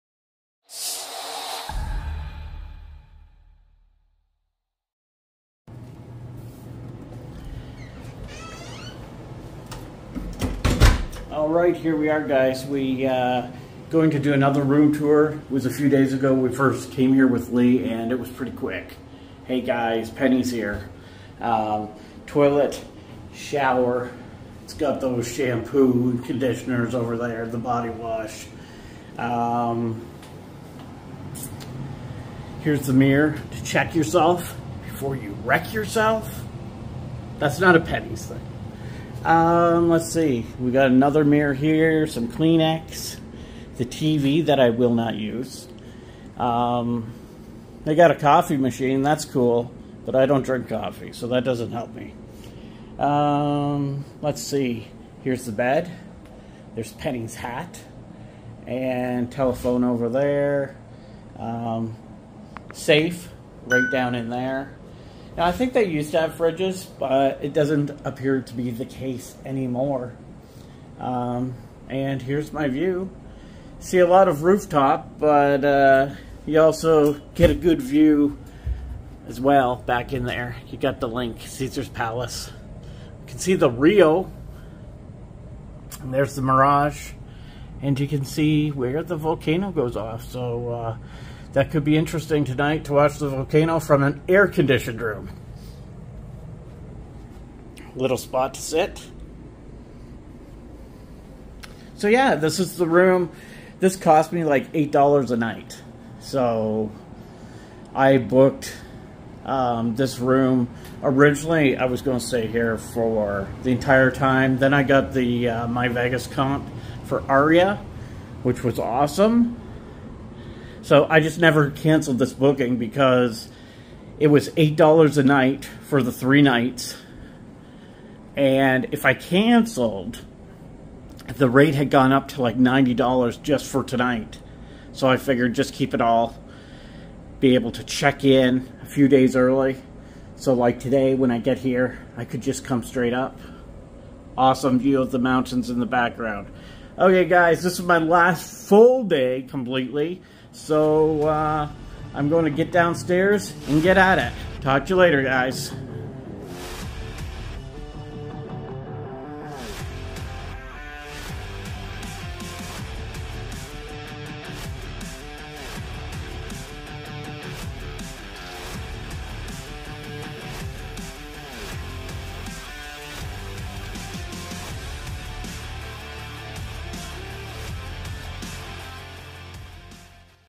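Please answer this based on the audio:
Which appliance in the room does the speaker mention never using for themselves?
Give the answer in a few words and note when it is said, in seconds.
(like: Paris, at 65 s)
coffee machine, at 48 s.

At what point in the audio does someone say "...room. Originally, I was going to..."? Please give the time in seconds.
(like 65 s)
110 s.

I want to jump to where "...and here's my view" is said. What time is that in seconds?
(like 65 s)
71 s.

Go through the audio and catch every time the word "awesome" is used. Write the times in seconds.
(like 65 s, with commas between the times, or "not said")
118 s, 144 s.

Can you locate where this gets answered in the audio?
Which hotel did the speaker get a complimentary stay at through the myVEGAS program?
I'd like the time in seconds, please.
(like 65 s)
117 s.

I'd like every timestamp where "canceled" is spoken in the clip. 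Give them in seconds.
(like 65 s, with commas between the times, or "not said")
121 s, 129 s.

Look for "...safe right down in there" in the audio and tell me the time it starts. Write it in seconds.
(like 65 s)
62 s.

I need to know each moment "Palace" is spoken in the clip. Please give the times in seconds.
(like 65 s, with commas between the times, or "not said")
81 s.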